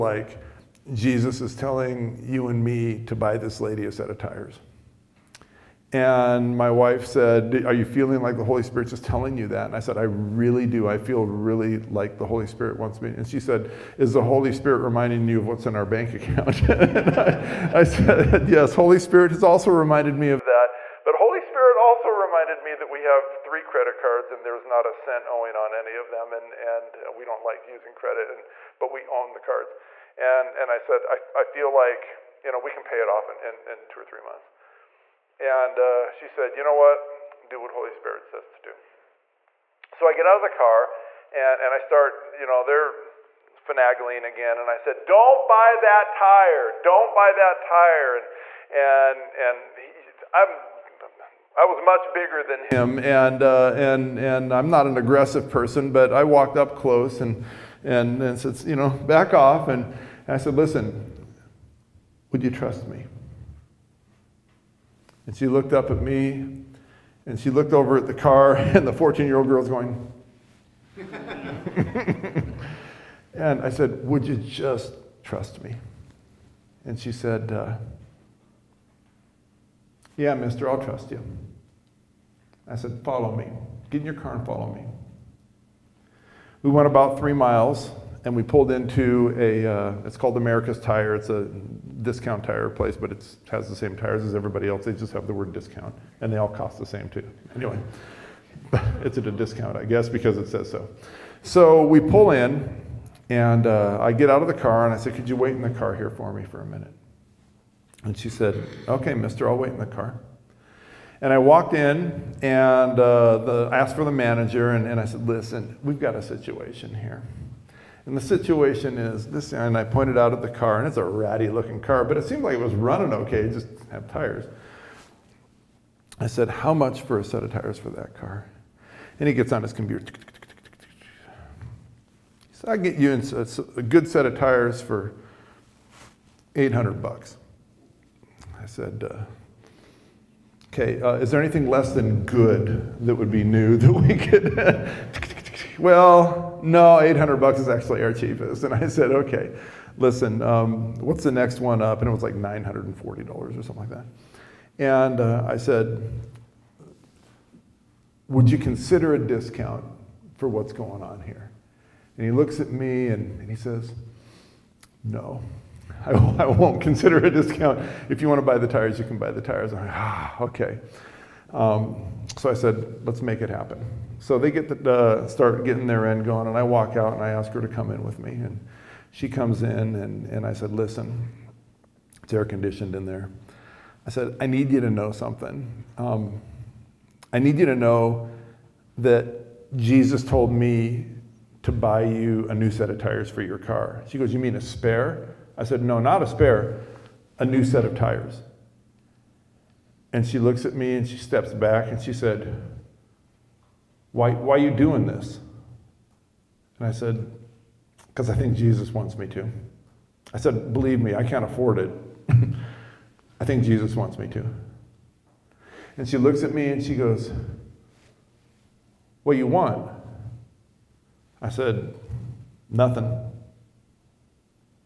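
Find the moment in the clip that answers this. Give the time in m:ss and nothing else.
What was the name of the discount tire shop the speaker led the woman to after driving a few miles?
1:30.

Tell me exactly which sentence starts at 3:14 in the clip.
She goes, You mean a spare?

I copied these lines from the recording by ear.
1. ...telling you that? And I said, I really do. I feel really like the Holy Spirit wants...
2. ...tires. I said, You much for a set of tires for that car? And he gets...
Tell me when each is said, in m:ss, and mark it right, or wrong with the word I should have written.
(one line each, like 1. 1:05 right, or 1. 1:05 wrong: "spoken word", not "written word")
1. 0:09 right
2. 2:04 wrong: "How", not "You".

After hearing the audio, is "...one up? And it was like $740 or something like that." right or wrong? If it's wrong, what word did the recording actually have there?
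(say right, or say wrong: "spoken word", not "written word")
wrong: "940", not "740".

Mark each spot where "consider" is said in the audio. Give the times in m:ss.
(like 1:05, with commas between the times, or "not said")
2:38, 2:46.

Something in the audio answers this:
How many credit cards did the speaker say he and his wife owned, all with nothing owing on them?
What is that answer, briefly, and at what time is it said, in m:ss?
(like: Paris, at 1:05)
3, at 0:23.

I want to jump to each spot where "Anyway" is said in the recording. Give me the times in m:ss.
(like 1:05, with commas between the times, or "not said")
1:37.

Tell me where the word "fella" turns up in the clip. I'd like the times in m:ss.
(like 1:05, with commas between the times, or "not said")
not said.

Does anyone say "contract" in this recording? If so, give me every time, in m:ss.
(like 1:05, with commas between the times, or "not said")
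not said.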